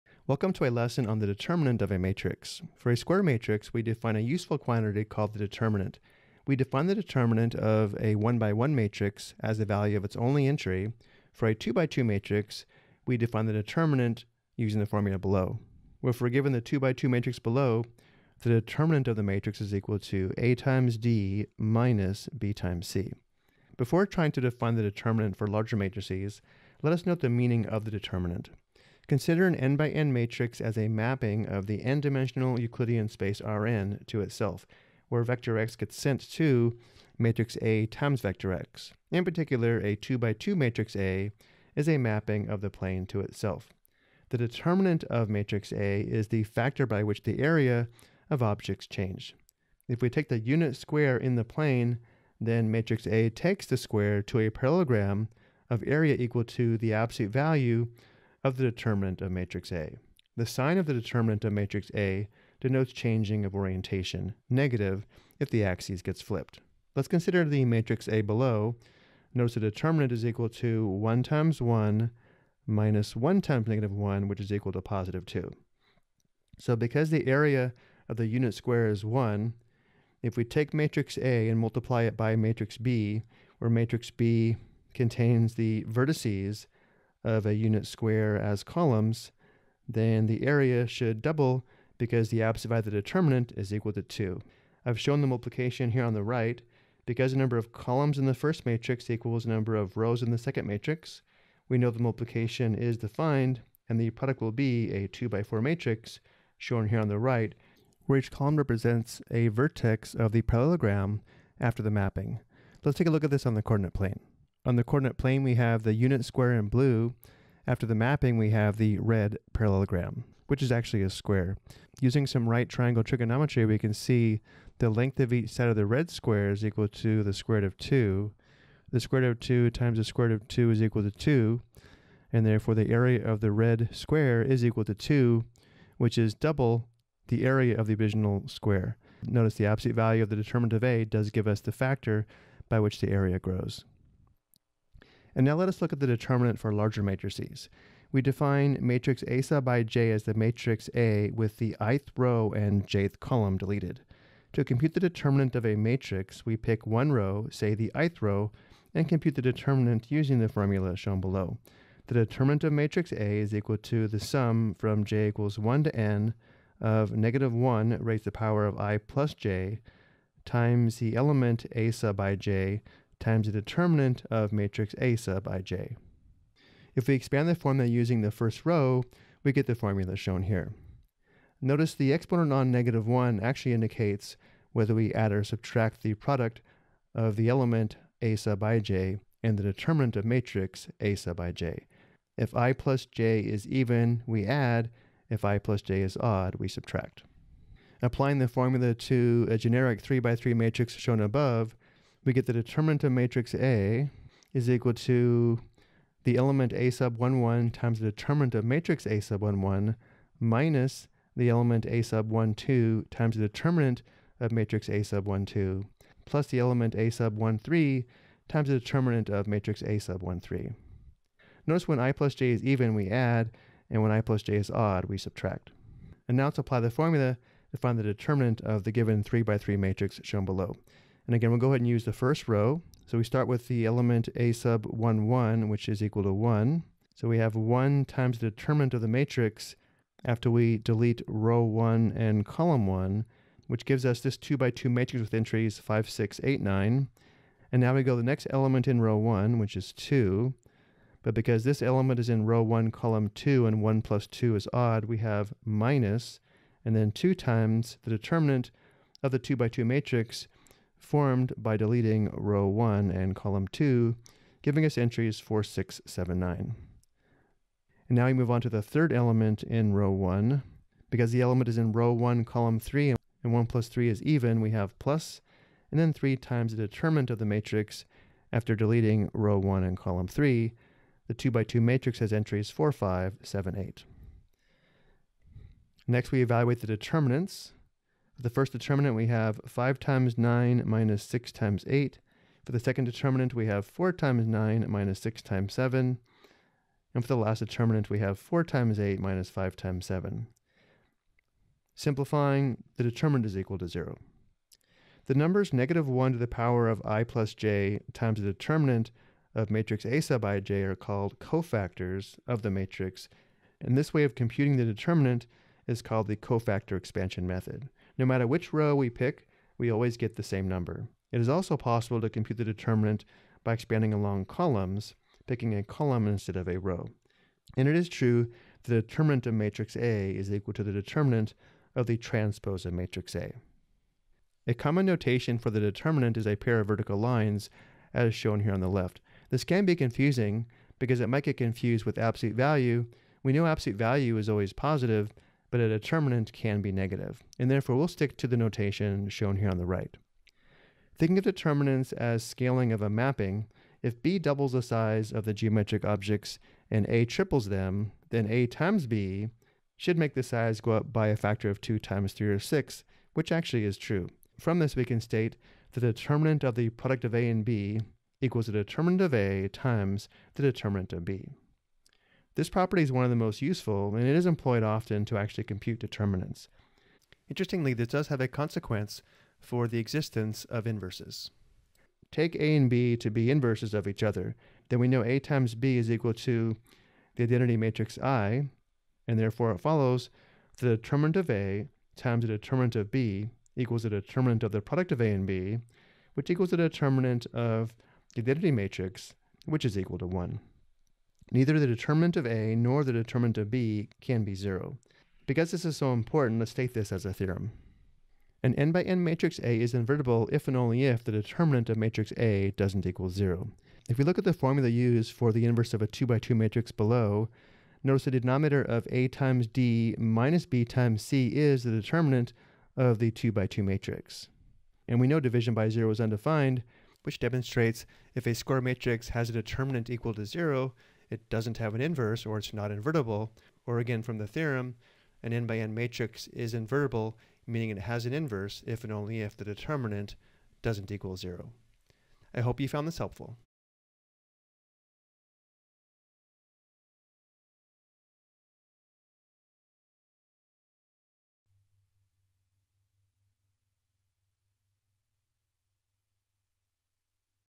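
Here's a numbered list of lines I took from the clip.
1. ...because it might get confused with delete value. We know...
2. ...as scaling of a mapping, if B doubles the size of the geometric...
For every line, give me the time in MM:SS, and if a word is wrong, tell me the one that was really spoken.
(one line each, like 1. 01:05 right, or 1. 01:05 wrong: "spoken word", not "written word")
1. 05:40 wrong: "absolute", not "delete"
2. 05:52 right.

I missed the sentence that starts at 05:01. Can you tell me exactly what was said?
Simplifying, the determinant is equal to 0.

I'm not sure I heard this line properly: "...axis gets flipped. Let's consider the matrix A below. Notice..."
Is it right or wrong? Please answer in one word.
right.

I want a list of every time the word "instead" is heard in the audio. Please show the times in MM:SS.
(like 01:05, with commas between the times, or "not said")
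05:26.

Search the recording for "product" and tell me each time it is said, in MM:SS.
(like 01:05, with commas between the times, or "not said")
01:44, 03:06, 06:06, 06:34.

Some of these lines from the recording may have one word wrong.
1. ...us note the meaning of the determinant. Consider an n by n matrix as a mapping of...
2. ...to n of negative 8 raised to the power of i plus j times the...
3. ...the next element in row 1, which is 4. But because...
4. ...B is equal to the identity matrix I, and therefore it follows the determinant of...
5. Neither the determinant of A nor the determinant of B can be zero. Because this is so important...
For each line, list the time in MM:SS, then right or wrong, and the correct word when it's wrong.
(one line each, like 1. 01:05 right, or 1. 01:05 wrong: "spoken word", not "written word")
1. 00:26 right
2. 02:45 wrong: "1", not "8"
3. 04:08 wrong: "2", not "4"
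4. 06:25 right
5. 06:41 right.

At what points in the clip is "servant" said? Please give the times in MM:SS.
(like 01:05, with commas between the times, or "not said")
not said.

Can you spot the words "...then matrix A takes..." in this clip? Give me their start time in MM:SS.
00:52.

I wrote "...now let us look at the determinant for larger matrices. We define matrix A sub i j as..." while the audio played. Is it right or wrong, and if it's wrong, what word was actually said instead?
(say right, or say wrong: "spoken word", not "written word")
right.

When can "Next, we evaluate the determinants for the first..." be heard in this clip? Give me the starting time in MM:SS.
04:46.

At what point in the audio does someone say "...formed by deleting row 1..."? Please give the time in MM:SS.
04:21.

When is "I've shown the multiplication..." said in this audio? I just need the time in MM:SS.
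01:34.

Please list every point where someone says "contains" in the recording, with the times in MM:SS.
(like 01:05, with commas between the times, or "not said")
01:24.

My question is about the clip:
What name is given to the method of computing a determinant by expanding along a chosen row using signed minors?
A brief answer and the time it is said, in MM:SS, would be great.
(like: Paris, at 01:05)
cofactor expansion method, at 05:16.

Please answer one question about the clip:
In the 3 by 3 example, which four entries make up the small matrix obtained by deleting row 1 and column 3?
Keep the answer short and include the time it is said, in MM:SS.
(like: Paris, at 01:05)
4, 5, 7, 8, at 04:42.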